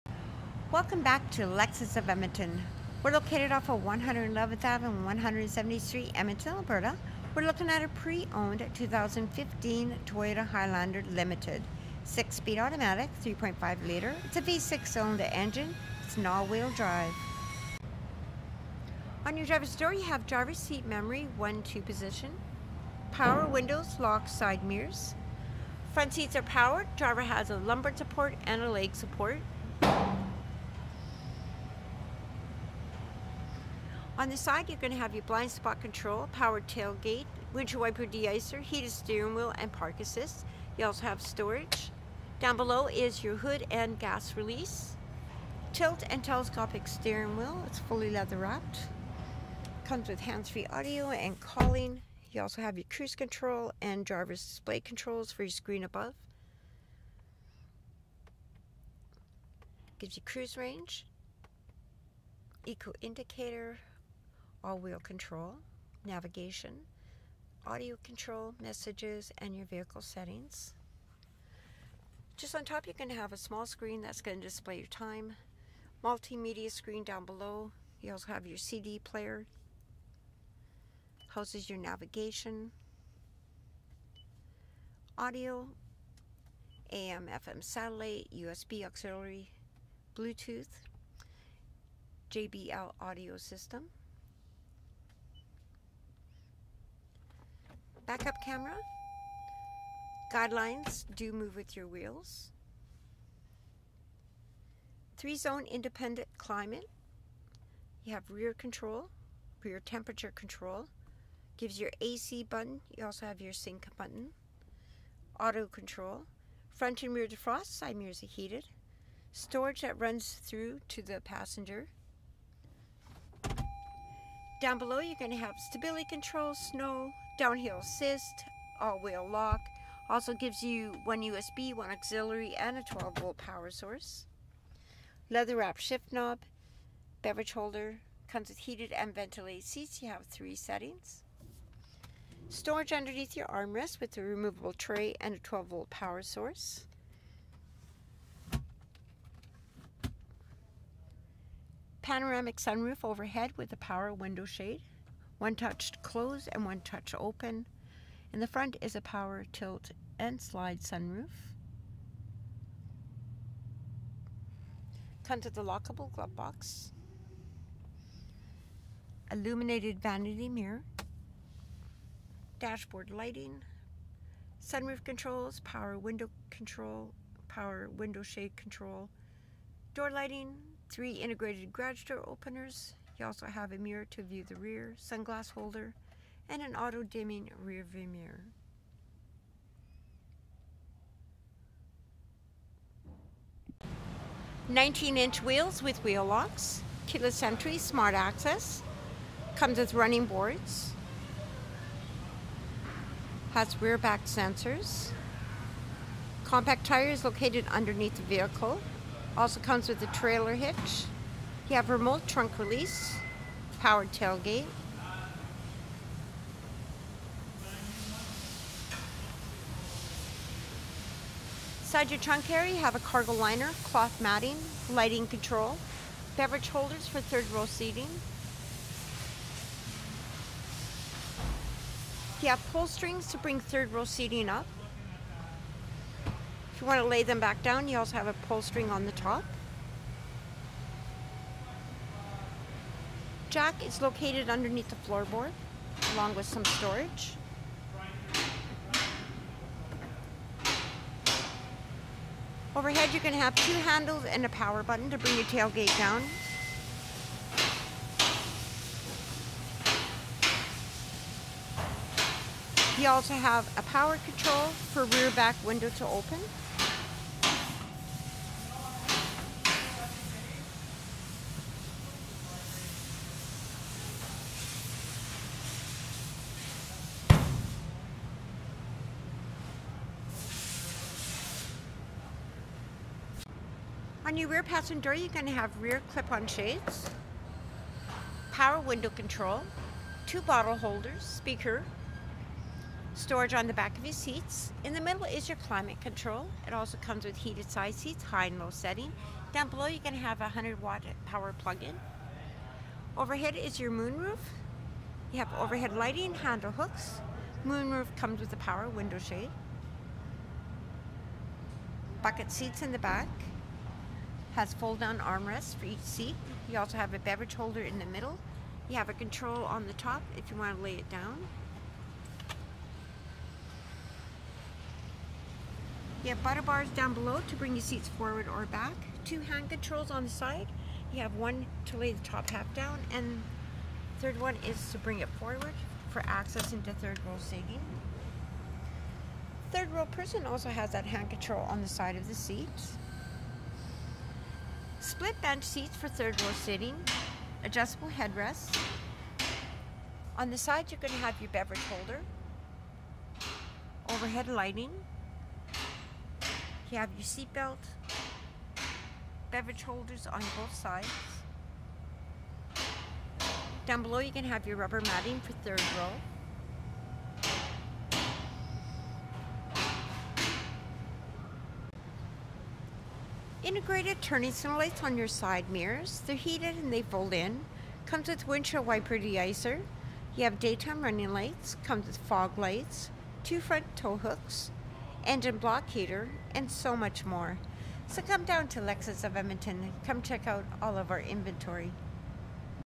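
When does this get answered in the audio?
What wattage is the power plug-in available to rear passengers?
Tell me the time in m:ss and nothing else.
5:00.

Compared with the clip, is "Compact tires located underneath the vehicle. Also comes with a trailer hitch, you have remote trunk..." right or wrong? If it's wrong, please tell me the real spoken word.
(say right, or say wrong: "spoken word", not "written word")
right.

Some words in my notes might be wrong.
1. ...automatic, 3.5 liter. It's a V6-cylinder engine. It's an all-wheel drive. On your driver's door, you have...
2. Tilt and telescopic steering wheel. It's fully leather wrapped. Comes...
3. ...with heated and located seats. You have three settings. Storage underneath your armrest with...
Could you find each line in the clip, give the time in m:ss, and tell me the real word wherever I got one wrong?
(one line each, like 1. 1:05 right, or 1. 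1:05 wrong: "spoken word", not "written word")
1. 0:12 right
2. 0:45 right
3. 2:18 wrong: "ventilated", not "located".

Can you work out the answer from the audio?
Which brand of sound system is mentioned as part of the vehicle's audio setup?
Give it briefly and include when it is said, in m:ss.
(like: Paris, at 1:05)
JBL, at 1:32.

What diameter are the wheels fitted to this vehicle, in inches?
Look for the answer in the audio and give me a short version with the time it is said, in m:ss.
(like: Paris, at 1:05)
19 inches, at 3:14.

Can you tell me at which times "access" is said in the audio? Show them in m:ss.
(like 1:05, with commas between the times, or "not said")
3:18, 5:36.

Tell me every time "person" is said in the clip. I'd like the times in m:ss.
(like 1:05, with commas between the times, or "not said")
5:40.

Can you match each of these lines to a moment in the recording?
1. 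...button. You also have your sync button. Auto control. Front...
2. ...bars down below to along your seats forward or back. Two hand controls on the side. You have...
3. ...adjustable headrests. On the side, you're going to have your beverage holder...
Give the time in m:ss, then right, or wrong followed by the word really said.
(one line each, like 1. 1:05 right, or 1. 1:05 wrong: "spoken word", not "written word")
1. 1:52 right
2. 5:26 wrong: "bring", not "along"
3. 5:47 right.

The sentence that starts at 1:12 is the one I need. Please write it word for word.
Just on top, you can have a small screen that's going to display your time, multimedia screen down below.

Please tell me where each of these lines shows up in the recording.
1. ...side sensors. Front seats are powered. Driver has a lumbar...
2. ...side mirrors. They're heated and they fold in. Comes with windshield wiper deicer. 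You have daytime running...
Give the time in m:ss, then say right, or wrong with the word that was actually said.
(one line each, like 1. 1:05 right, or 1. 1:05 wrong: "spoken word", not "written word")
1. 0:24 wrong: "mirrors", not "sensors"
2. 6:15 right.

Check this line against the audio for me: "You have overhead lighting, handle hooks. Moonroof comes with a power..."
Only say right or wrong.
right.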